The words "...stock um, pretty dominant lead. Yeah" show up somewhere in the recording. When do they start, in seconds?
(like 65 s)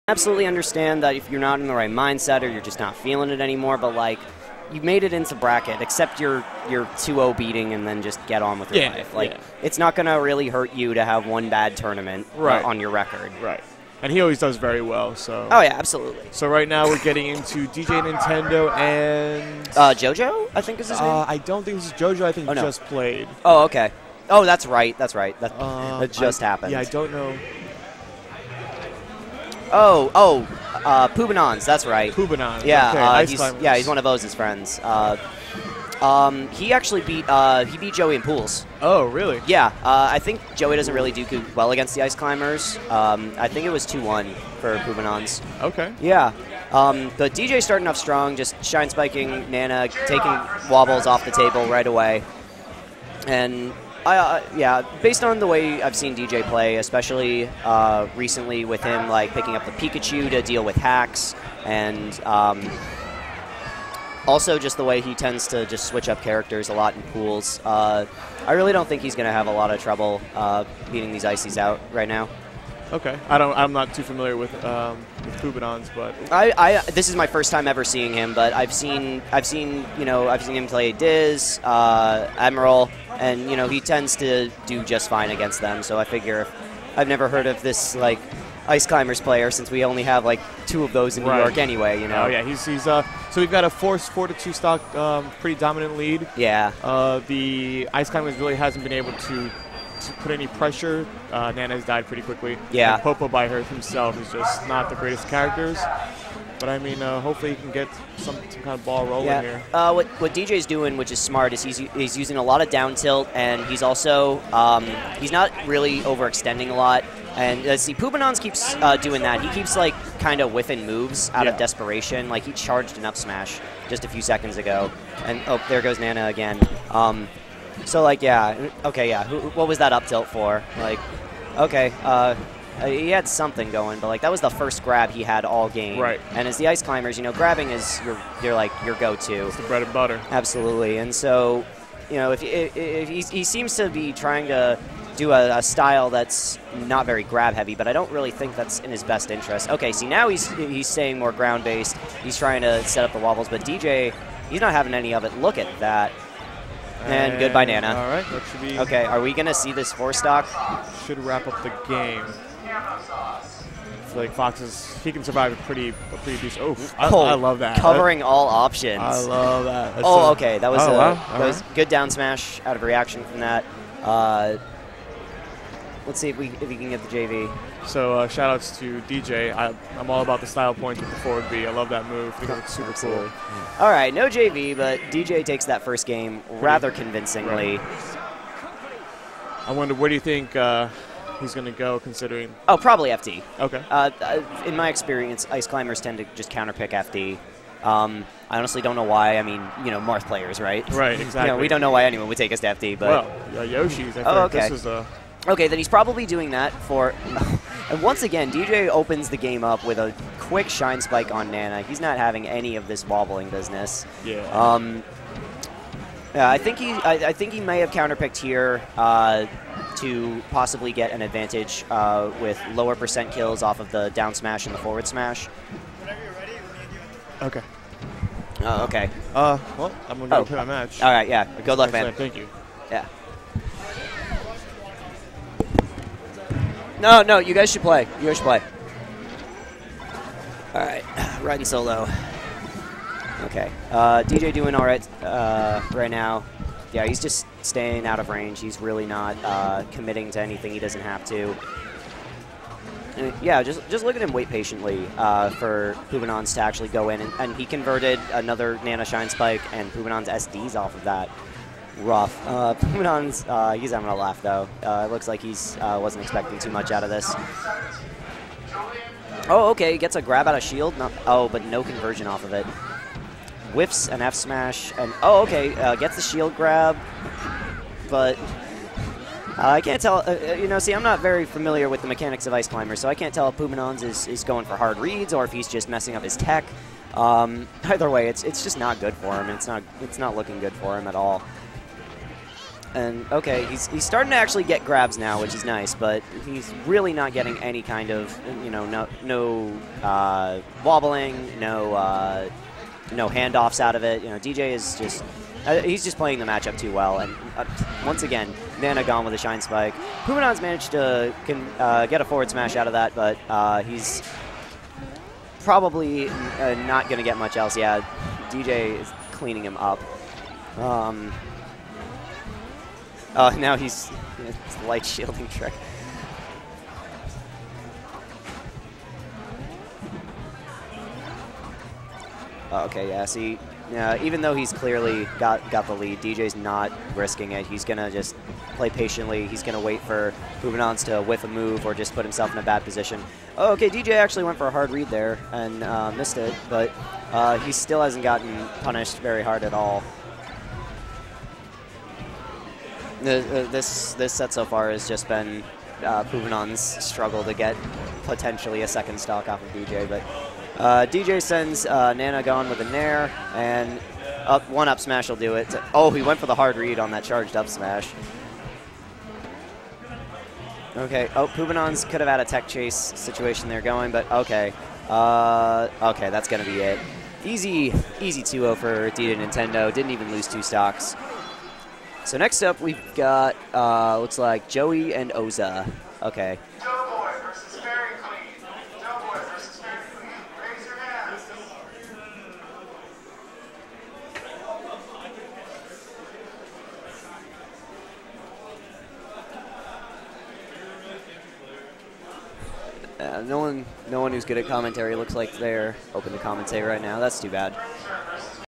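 94 s.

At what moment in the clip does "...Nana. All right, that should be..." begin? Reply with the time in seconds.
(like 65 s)
157 s.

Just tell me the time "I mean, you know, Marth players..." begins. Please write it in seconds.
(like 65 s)
199 s.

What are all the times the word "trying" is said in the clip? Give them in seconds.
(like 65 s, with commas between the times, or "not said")
144 s, 152 s.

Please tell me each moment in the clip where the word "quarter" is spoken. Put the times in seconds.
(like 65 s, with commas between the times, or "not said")
not said.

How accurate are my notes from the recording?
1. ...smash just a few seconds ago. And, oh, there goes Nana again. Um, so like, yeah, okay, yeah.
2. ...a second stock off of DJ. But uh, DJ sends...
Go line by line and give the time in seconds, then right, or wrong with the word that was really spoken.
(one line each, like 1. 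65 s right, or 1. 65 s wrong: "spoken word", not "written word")
1. 123 s right
2. 358 s right.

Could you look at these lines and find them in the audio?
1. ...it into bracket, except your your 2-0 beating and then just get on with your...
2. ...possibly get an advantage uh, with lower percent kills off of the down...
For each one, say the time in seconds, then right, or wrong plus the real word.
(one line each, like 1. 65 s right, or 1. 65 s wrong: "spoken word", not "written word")
1. 5 s right
2. 220 s right.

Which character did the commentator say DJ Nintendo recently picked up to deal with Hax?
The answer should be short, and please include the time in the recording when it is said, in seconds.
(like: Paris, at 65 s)
Pikachu, at 59 s.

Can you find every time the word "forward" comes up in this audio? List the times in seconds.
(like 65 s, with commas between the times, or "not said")
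181 s, 224 s, 312 s.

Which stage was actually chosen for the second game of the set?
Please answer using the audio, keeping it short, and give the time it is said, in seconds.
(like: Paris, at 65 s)
Yoshi's, at 203 s.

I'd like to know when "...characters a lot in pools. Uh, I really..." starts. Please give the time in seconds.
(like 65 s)
66 s.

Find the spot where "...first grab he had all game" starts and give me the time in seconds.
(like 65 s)
134 s.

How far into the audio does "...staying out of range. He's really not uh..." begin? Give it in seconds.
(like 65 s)
247 s.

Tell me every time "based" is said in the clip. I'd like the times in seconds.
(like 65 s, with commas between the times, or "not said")
55 s, 151 s.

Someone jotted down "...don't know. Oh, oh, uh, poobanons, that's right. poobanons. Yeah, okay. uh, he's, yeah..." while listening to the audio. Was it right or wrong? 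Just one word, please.
right.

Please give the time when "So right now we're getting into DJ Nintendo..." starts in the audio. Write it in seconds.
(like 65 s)
16 s.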